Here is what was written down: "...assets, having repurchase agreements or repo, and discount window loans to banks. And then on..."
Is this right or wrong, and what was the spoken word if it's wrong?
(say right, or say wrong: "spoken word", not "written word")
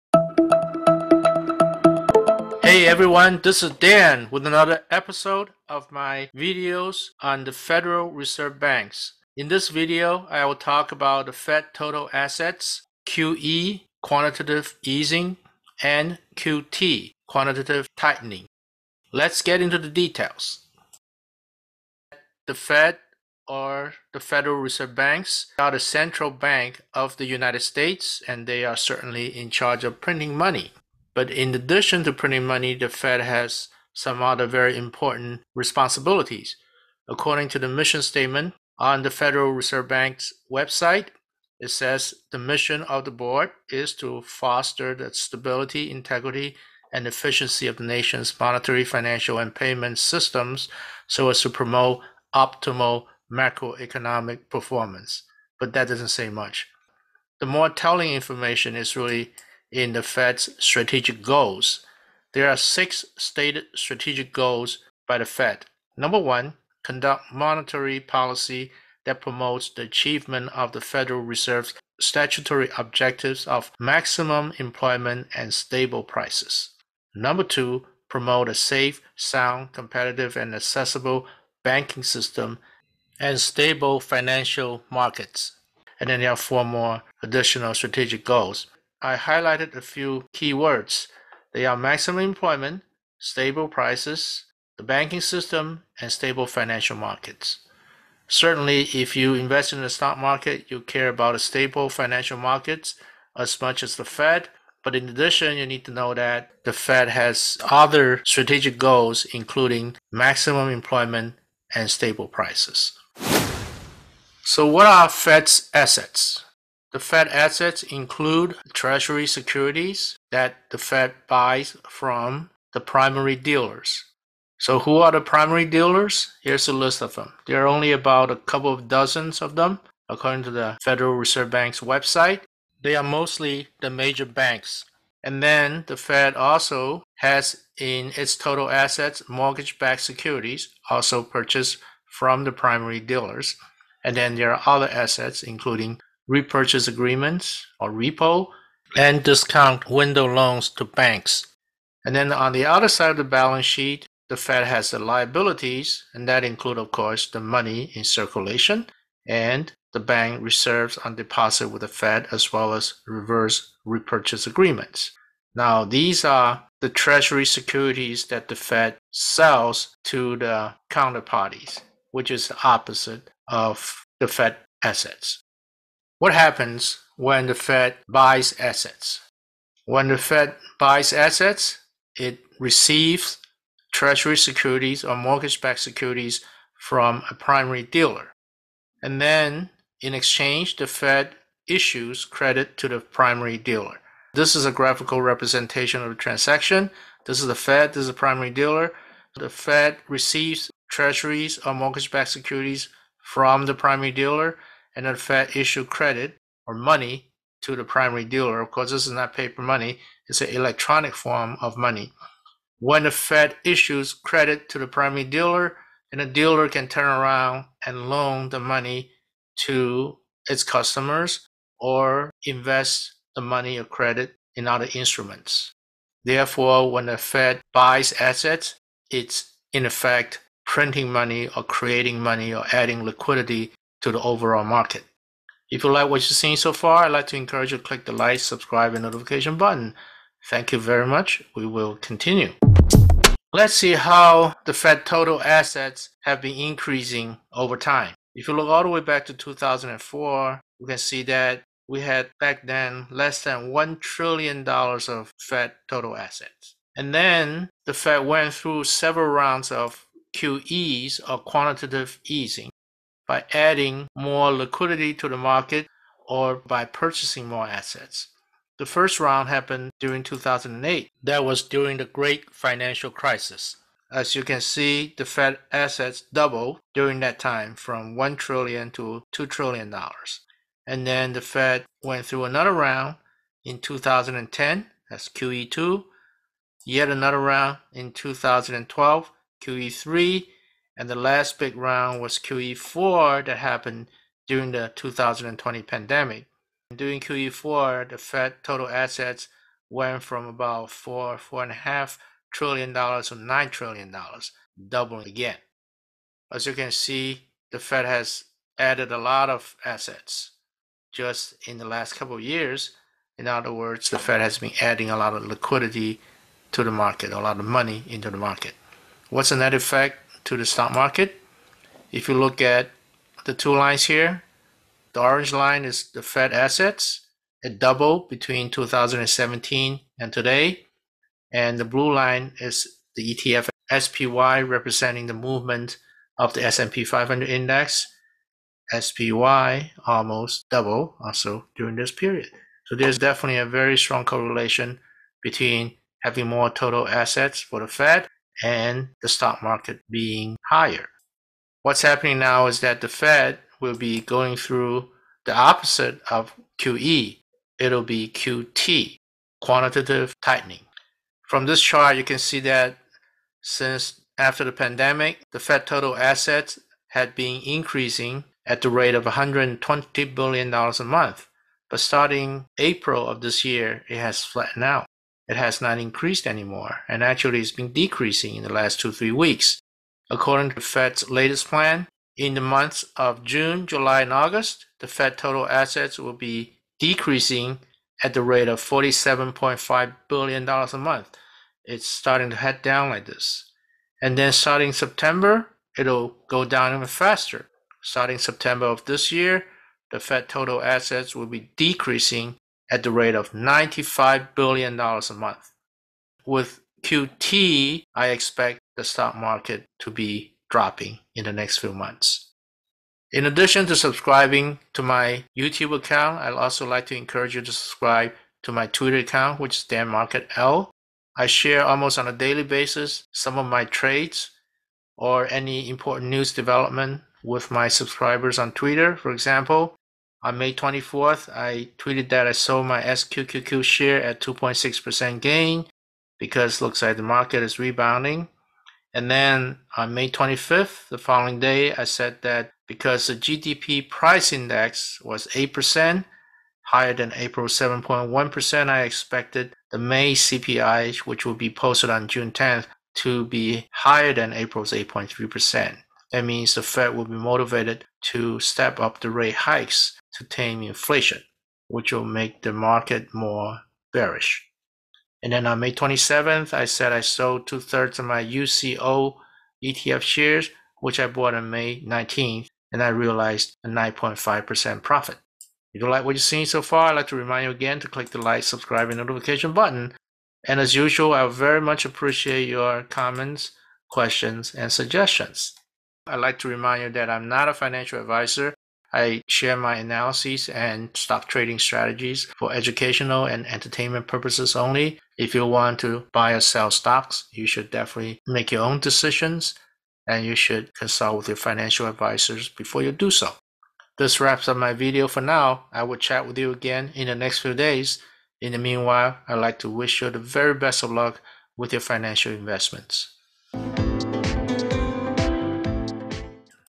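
wrong: "including", not "having".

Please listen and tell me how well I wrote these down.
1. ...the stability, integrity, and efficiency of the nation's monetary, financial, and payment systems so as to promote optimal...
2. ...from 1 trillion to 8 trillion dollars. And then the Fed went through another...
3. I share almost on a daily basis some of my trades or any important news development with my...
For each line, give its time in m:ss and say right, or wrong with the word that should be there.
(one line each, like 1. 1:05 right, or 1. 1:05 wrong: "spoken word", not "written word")
1. 0:44 right
2. 4:37 wrong: "2", not "8"
3. 7:01 right.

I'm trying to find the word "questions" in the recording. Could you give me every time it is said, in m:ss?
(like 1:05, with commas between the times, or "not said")
8:04.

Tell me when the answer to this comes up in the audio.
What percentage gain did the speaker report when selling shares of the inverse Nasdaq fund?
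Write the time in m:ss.
7:14.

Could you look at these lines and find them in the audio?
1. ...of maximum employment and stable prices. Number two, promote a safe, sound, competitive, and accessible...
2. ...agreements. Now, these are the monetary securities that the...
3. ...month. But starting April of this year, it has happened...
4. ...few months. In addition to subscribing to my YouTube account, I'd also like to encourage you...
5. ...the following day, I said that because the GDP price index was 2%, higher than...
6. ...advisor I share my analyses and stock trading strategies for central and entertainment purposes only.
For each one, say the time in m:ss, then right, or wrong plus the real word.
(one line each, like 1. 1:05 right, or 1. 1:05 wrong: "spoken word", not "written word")
1. 1:13 right
2. 2:44 wrong: "treasury", not "monetary"
3. 6:11 wrong: "flattened", not "happened"
4. 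6:51 right
5. 7:21 wrong: "8", not "2"
6. 8:08 wrong: "educational", not "central".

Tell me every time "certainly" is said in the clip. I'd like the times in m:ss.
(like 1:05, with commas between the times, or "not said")
0:28, 1:38.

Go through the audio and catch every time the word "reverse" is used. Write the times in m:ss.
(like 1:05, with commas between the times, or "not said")
2:43.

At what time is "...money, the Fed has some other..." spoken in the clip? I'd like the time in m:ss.
0:32.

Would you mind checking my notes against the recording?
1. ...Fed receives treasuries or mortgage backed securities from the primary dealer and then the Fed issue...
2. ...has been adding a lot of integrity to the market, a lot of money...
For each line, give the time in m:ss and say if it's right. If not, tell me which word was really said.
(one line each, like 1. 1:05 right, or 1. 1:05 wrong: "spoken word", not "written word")
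1. 3:19 right
2. 5:14 wrong: "liquidity", not "integrity".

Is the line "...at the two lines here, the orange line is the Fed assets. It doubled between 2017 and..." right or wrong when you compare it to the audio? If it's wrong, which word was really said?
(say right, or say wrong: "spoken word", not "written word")
right.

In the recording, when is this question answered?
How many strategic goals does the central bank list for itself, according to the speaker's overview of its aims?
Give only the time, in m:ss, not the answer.
1:02.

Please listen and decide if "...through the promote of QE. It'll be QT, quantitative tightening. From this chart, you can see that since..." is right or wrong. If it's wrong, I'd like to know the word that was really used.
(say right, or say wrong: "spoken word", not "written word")
wrong: "opposite", not "promote".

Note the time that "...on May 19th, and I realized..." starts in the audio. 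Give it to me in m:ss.
7:51.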